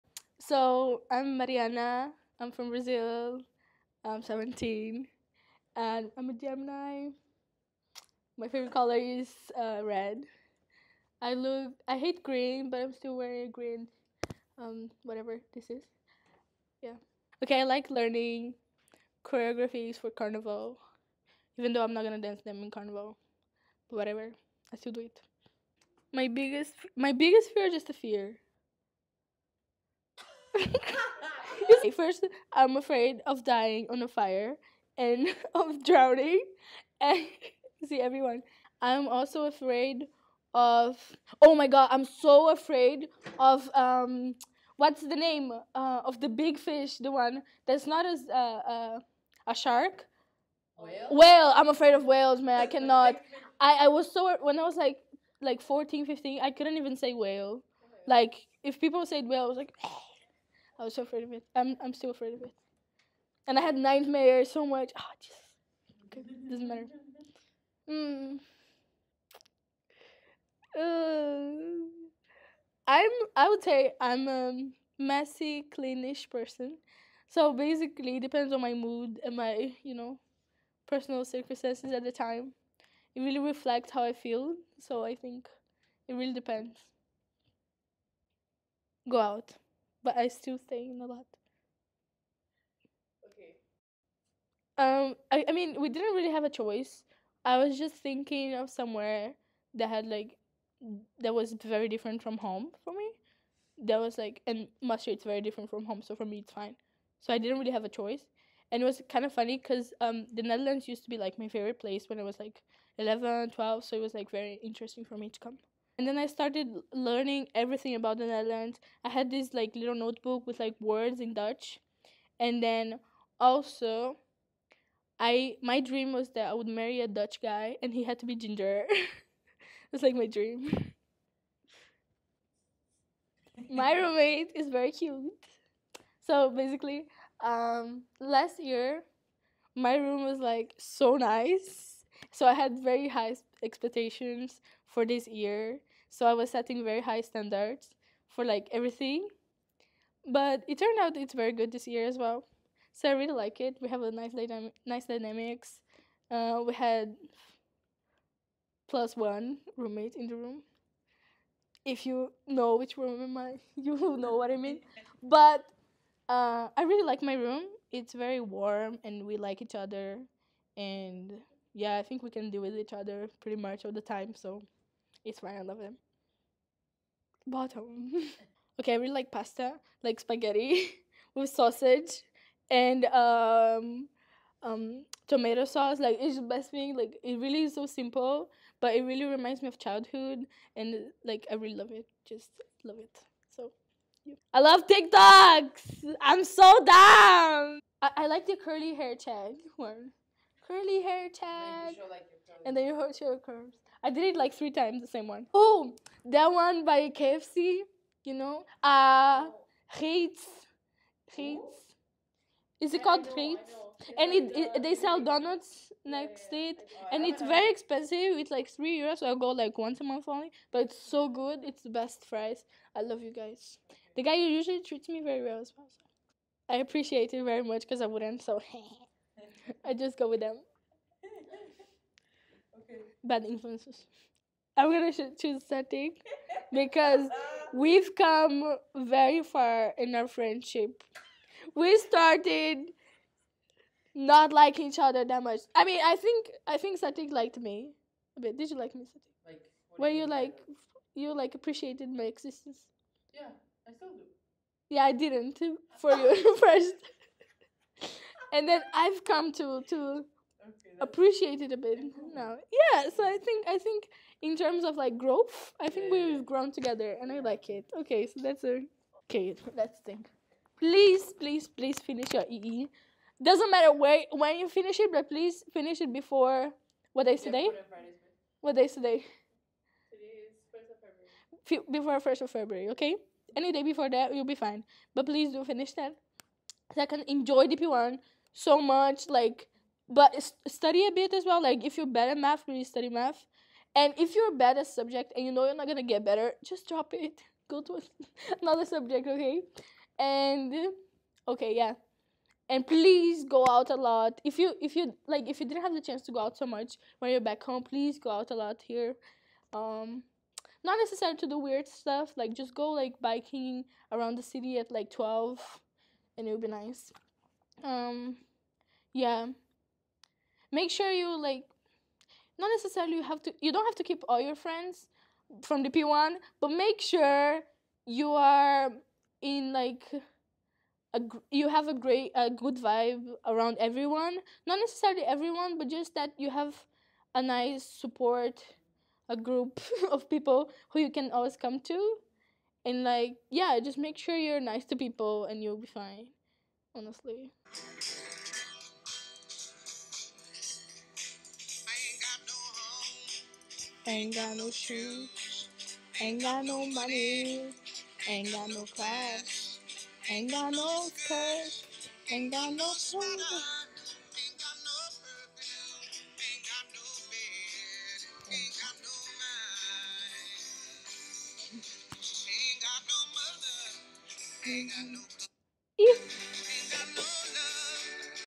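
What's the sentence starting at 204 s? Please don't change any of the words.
I did it like three times, the same one.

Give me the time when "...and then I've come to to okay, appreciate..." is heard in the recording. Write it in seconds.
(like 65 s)
258 s.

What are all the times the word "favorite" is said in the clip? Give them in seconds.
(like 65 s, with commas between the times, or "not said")
8 s, 111 s.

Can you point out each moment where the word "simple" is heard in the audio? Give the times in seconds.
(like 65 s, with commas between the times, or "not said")
187 s.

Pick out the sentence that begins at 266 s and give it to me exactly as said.
we've grown together, and I like it.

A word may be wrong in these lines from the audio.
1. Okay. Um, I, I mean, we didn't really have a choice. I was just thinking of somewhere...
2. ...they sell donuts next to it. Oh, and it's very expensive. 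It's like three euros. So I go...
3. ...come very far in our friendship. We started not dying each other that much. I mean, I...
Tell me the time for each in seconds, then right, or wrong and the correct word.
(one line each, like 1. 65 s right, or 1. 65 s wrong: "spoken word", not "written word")
1. 93 s right
2. 214 s right
3. 238 s wrong: "liking", not "dying".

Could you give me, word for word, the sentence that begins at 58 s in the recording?
Like if people said whale, I was like.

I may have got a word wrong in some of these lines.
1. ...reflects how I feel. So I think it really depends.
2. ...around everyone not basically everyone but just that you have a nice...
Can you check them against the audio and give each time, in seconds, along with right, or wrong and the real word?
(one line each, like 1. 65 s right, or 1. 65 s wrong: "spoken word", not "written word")
1. 83 s right
2. 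333 s wrong: "necessarily", not "basically".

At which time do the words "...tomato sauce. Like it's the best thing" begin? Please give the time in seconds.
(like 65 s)
185 s.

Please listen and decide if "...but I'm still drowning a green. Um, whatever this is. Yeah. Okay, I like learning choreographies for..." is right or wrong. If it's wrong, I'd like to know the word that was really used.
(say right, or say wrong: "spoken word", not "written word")
wrong: "wearing", not "drowning".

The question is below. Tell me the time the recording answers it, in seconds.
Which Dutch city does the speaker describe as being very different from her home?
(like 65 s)
104 s.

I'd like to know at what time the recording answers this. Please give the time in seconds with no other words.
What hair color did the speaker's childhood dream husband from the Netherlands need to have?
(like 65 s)
128 s.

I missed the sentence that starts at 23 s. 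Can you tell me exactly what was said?
But whatever, I still do it.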